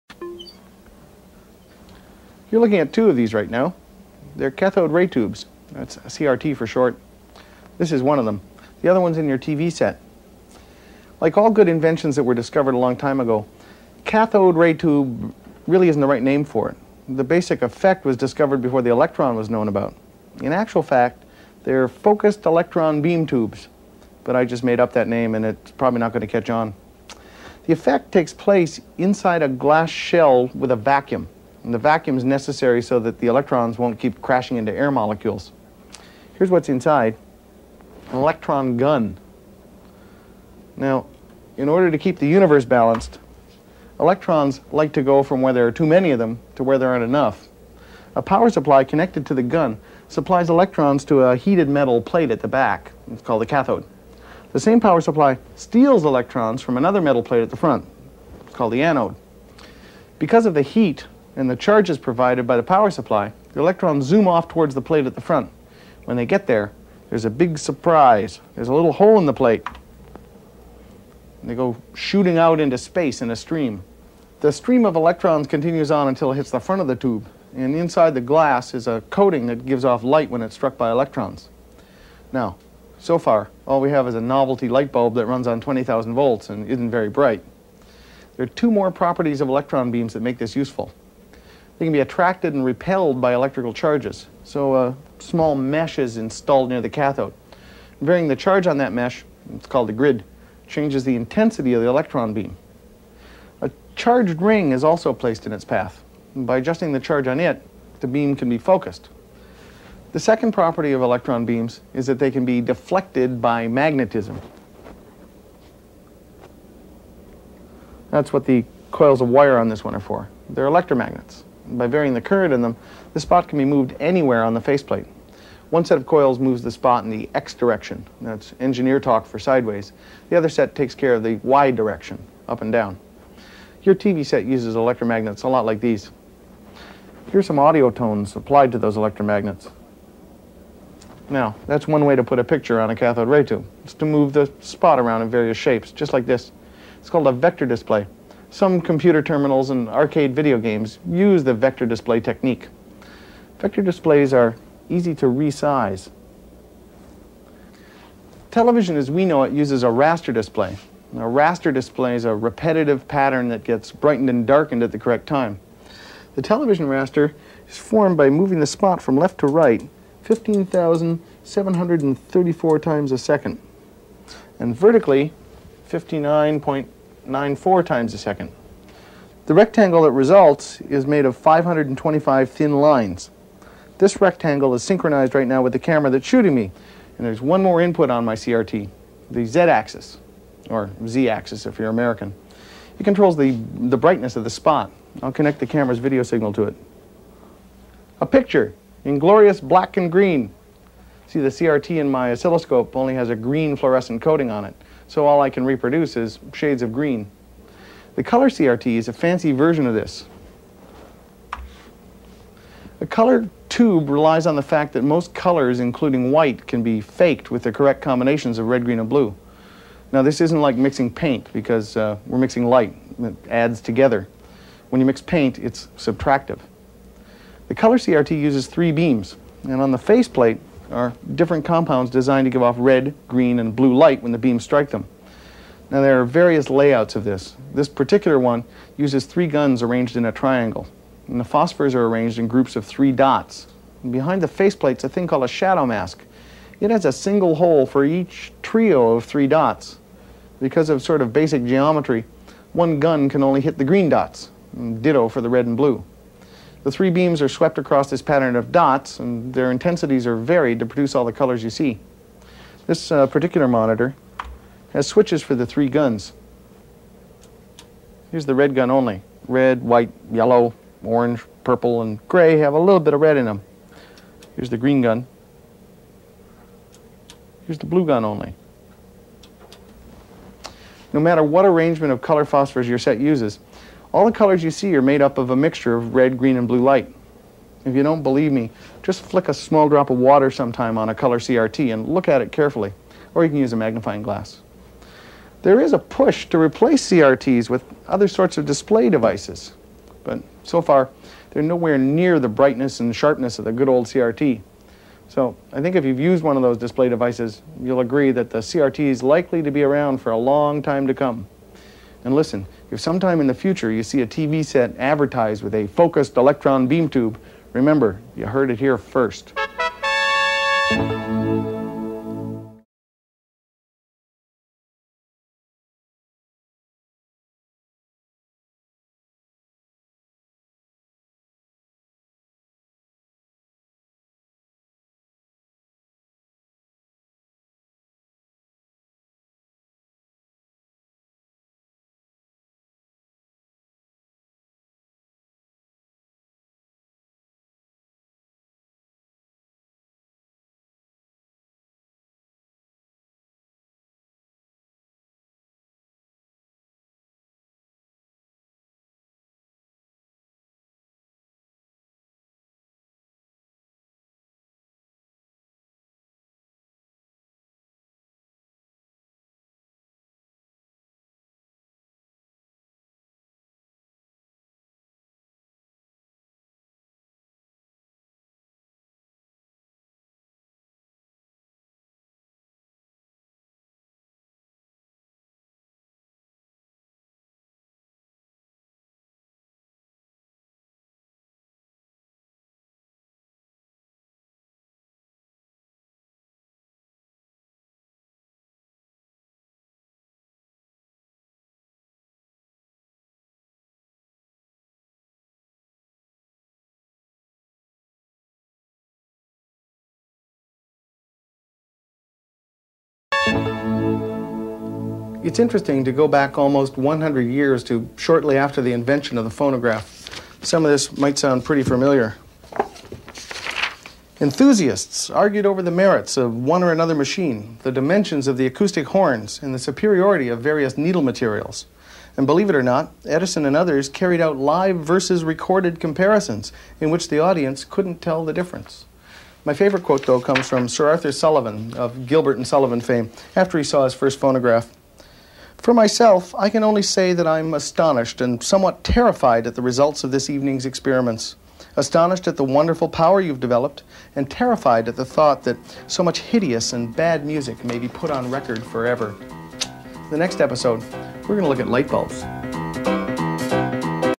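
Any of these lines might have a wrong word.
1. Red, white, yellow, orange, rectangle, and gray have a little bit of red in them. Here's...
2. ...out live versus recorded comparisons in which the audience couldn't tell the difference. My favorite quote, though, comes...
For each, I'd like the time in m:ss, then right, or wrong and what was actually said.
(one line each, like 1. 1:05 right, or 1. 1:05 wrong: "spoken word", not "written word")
1. 4:29 wrong: "purple", not "rectangle"
2. 7:14 right.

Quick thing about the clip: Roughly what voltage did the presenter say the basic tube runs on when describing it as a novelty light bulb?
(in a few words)
20,000 volts.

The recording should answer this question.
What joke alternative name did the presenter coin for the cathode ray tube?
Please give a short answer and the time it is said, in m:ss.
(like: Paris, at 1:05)
focused electron beam tubes, at 0:21.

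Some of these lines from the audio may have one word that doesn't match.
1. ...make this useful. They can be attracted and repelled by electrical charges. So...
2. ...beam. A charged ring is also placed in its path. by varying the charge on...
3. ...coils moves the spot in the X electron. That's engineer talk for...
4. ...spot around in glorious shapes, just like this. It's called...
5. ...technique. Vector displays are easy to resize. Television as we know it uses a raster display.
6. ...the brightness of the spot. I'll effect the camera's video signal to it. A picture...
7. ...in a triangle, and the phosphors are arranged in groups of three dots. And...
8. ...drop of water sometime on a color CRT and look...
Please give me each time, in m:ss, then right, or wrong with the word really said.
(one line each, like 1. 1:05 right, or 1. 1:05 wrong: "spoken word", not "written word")
1. 1:30 right
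2. 1:42 wrong: "adjusting", not "varying"
3. 2:06 wrong: "direction", not "electron"
4. 2:24 wrong: "various", not "glorious"
5. 2:32 right
6. 3:13 wrong: "connect", not "effect"
7. 4:00 right
8. 4:49 right.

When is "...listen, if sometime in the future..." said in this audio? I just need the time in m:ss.
5:12.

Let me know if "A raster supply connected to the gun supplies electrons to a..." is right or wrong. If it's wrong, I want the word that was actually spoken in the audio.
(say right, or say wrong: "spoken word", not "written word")
wrong: "power", not "raster".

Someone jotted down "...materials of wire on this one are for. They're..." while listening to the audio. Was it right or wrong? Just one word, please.
wrong.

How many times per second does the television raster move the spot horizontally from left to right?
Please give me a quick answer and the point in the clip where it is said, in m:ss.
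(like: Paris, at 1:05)
15,734, at 2:50.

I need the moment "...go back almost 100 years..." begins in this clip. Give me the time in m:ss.
6:56.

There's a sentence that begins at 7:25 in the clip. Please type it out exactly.
For myself, I can only say that I'm astonished and somewhat terrified at the results of this evening's experiments.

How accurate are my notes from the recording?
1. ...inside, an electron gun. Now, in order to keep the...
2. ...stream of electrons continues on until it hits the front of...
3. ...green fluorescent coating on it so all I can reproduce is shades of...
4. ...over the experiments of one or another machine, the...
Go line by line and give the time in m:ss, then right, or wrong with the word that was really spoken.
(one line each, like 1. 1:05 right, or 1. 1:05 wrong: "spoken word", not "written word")
1. 0:36 right
2. 1:14 right
3. 3:23 right
4. 7:05 wrong: "merits", not "experiments".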